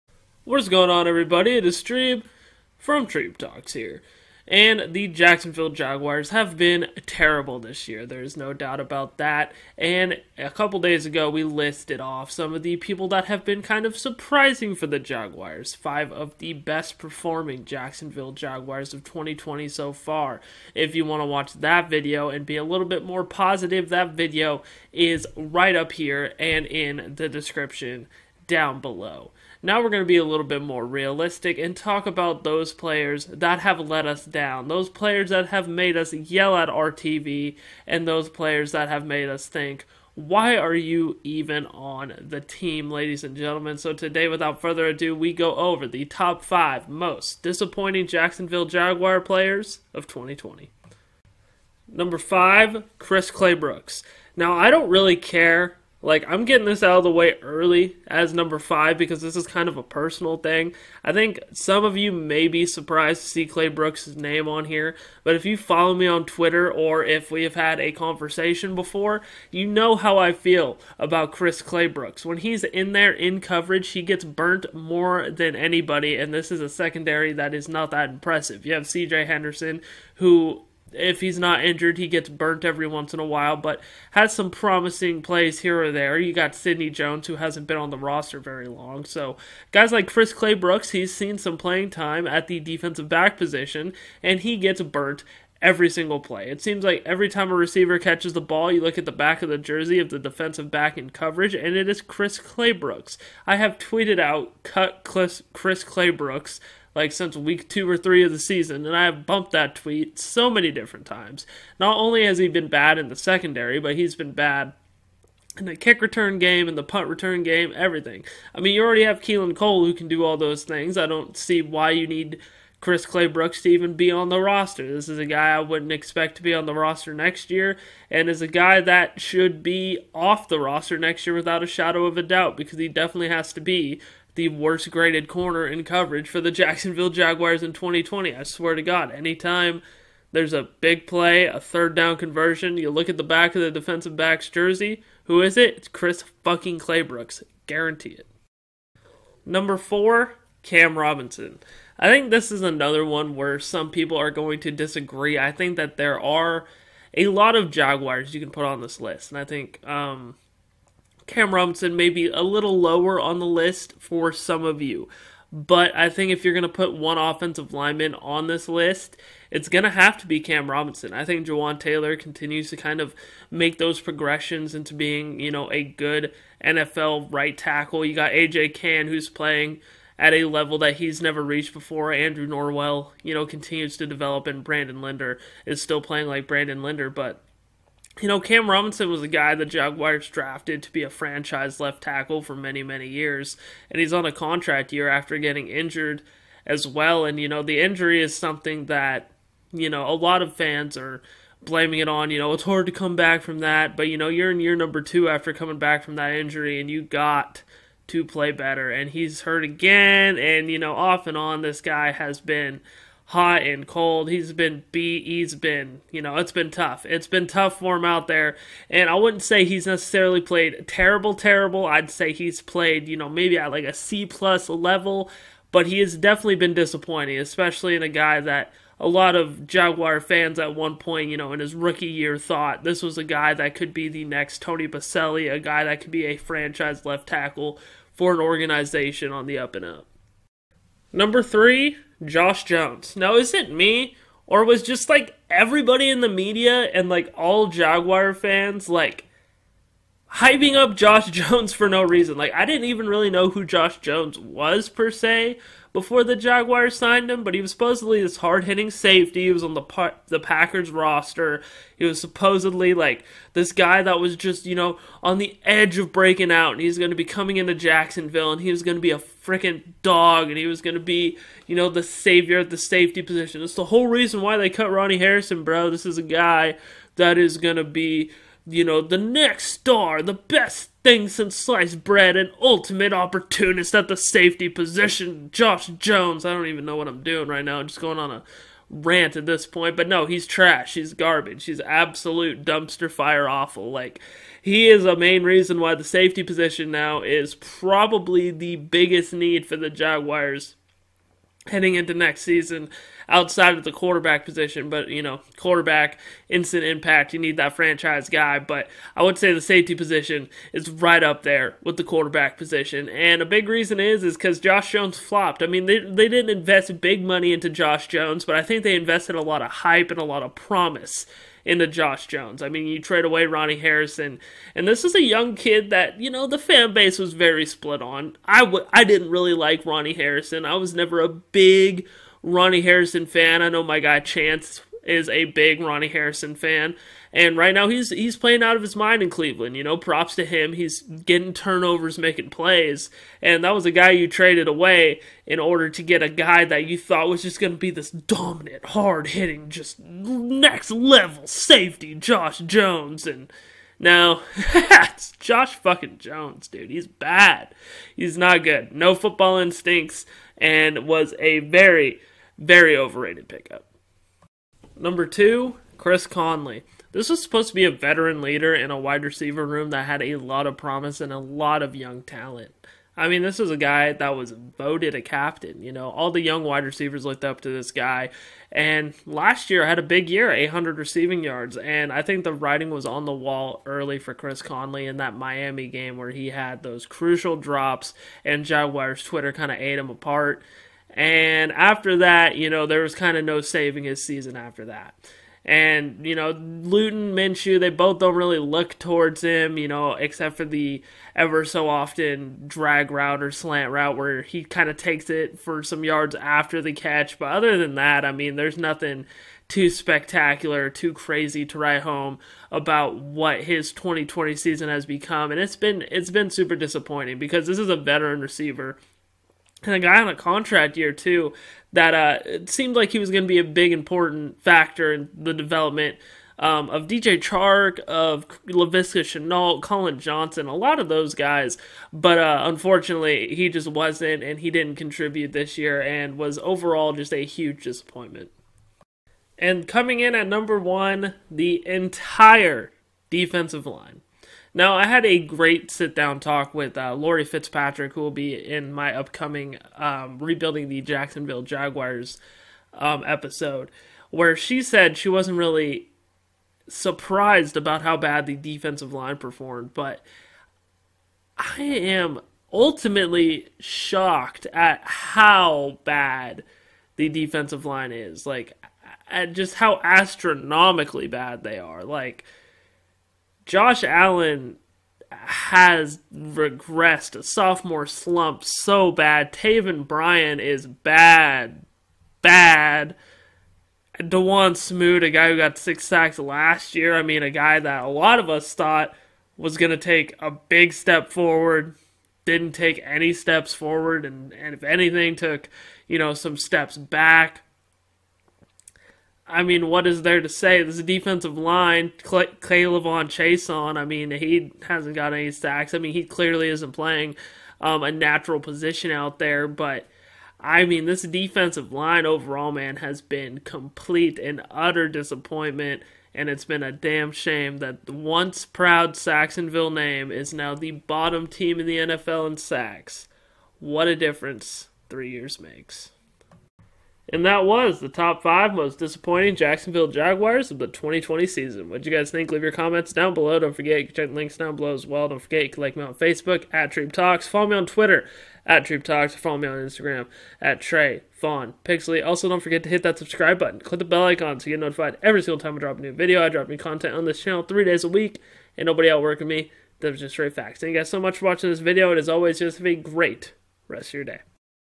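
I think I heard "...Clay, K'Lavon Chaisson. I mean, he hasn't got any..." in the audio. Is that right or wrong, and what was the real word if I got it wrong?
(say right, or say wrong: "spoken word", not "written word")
right.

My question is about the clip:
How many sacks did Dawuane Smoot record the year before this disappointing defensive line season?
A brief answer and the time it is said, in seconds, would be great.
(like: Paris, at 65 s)
6, at 485 s.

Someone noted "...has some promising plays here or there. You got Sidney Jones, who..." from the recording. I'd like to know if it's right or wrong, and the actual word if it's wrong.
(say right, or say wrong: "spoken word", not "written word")
right.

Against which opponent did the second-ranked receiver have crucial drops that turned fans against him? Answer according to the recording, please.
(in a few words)
Miami.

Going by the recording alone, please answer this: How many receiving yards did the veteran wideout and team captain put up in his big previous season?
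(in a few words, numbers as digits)
800.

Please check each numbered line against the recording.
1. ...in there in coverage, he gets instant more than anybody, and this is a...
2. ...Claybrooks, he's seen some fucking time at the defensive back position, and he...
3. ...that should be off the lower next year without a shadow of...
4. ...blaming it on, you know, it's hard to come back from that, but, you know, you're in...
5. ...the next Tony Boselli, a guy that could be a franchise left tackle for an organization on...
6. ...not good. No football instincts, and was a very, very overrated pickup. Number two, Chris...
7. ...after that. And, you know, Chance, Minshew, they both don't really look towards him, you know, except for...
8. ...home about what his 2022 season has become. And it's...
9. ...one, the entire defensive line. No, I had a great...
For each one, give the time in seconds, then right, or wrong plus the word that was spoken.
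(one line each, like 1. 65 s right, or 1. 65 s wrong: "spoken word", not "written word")
1. 72 s wrong: "burnt", not "instant"
2. 90 s wrong: "playing", not "fucking"
3. 128 s wrong: "roster", not "lower"
4. 201 s right
5. 234 s right
6. 358 s right
7. 394 s wrong: "Luton", not "Chance"
8. 412 s wrong: "2020", not "2022"
9. 440 s right.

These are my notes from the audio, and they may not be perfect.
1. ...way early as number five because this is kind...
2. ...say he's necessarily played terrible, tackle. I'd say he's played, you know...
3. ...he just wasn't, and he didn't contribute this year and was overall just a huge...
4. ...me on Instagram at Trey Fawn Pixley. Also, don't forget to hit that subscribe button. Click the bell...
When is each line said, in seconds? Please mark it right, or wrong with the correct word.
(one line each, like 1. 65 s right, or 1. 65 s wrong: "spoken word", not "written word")
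1. 57 s right
2. 219 s wrong: "terrible", not "tackle"
3. 433 s right
4. 539 s right.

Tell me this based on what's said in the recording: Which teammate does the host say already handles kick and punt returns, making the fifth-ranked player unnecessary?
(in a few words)
Keelan Cole.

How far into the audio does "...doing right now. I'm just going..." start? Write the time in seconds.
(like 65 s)
287 s.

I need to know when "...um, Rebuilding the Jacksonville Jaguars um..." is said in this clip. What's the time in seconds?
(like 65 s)
449 s.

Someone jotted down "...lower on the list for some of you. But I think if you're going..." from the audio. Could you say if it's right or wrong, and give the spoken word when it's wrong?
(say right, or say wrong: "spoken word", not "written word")
right.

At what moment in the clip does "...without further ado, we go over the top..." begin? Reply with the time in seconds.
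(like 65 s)
44 s.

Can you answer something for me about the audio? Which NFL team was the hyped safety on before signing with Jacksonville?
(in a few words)
Packers.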